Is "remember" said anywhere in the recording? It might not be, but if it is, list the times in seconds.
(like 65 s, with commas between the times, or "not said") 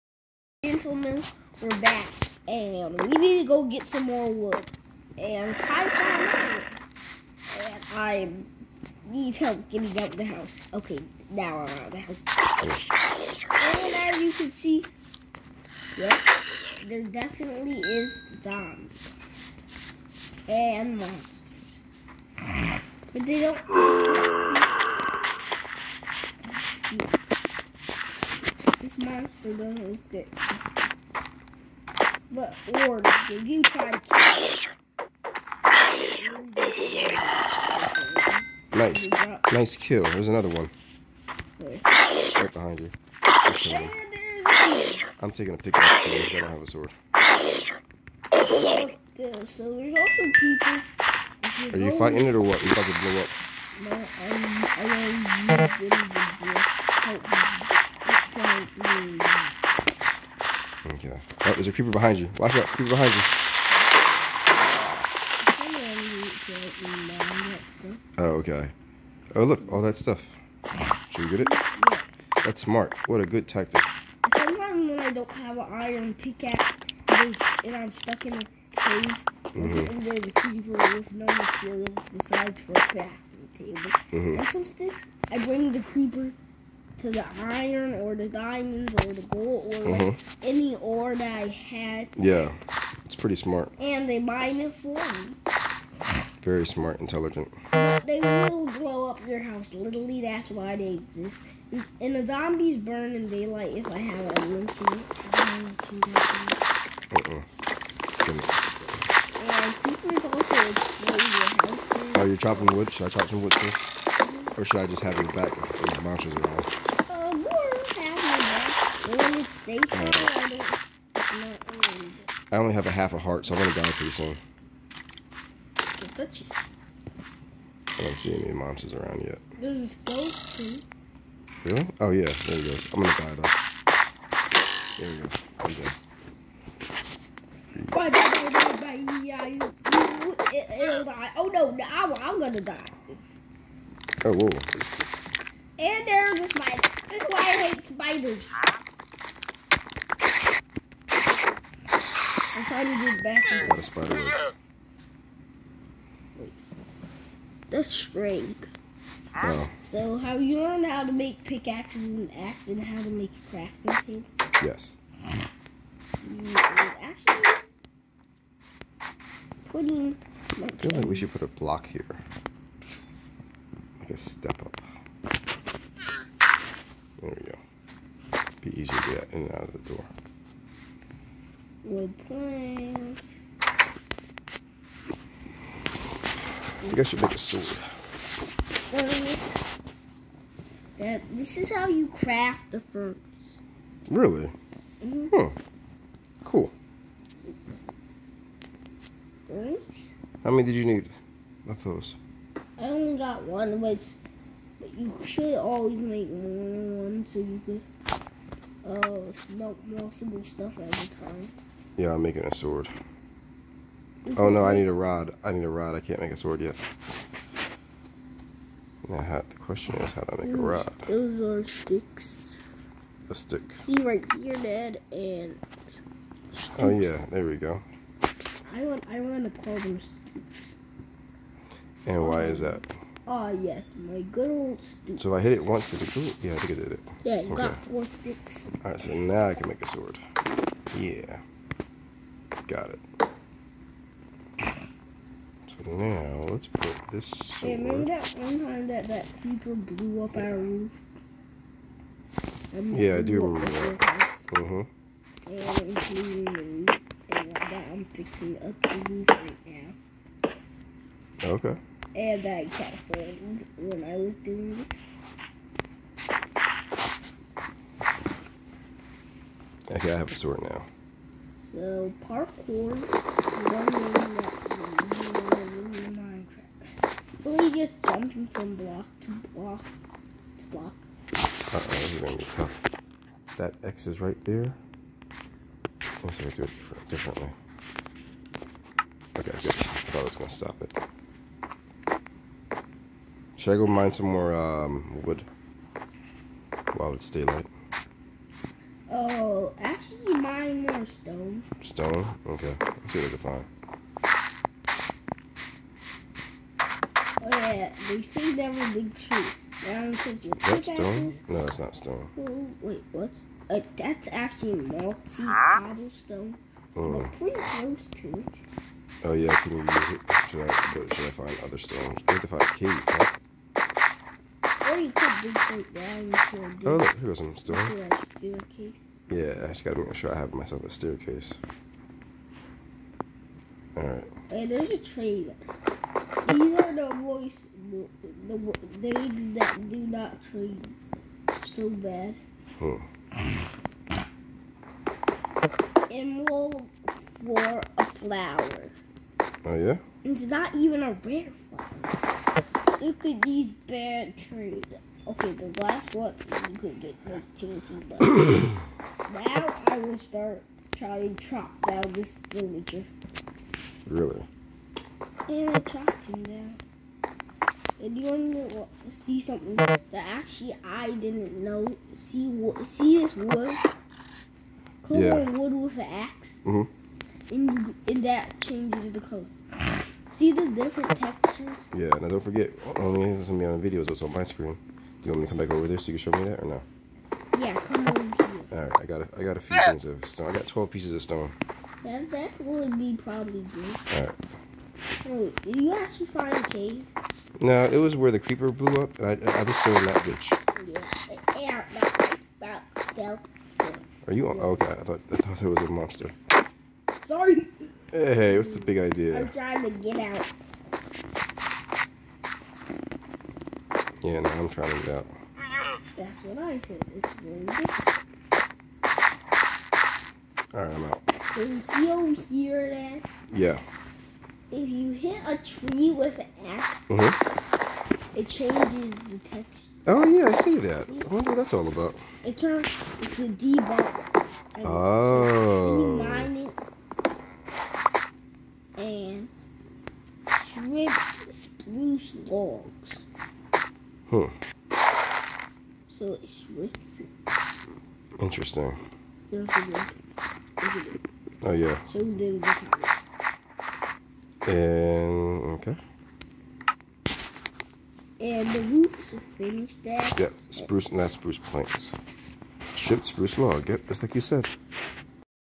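247 s, 253 s.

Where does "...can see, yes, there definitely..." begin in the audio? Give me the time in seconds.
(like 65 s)
14 s.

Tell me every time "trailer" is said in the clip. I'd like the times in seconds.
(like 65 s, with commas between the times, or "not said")
334 s.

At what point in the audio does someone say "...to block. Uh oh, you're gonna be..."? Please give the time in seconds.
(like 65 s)
280 s.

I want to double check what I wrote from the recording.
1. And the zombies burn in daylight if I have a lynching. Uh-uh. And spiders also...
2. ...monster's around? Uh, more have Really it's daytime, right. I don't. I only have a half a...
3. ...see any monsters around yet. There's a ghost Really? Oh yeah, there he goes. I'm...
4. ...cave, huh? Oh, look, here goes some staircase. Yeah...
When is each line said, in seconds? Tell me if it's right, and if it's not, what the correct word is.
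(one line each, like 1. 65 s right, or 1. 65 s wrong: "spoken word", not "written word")
1. 102 s wrong: "creepers", not "spiders"
2. 116 s wrong: "When", not "Really"
3. 128 s right
4. 322 s right.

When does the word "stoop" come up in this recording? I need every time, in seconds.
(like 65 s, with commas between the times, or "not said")
234 s.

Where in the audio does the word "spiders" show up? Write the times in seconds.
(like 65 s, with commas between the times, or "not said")
147 s, 153 s.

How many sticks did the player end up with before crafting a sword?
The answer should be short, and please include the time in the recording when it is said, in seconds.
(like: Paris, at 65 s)
4, at 237 s.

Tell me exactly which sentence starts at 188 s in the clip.
Uh, this is how you craft the furnace.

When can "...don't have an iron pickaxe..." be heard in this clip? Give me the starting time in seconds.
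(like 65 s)
75 s.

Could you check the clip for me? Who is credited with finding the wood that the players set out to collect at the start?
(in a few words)
Kai.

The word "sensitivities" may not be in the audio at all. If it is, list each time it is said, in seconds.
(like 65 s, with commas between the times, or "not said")
not said.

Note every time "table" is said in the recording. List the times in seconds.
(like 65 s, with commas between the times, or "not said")
83 s, 164 s.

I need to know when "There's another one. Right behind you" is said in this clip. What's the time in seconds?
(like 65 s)
40 s.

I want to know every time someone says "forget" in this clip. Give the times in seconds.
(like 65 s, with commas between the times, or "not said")
382 s.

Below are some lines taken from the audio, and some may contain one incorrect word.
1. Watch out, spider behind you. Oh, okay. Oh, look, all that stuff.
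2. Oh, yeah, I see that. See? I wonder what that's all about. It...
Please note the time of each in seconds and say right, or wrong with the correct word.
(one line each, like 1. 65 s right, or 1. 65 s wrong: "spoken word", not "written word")
1. 62 s wrong: "creeper", not "spider"
2. 430 s right.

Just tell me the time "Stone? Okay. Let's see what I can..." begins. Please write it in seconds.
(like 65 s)
301 s.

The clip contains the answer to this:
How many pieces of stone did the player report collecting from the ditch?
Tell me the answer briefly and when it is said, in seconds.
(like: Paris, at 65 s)
12, at 390 s.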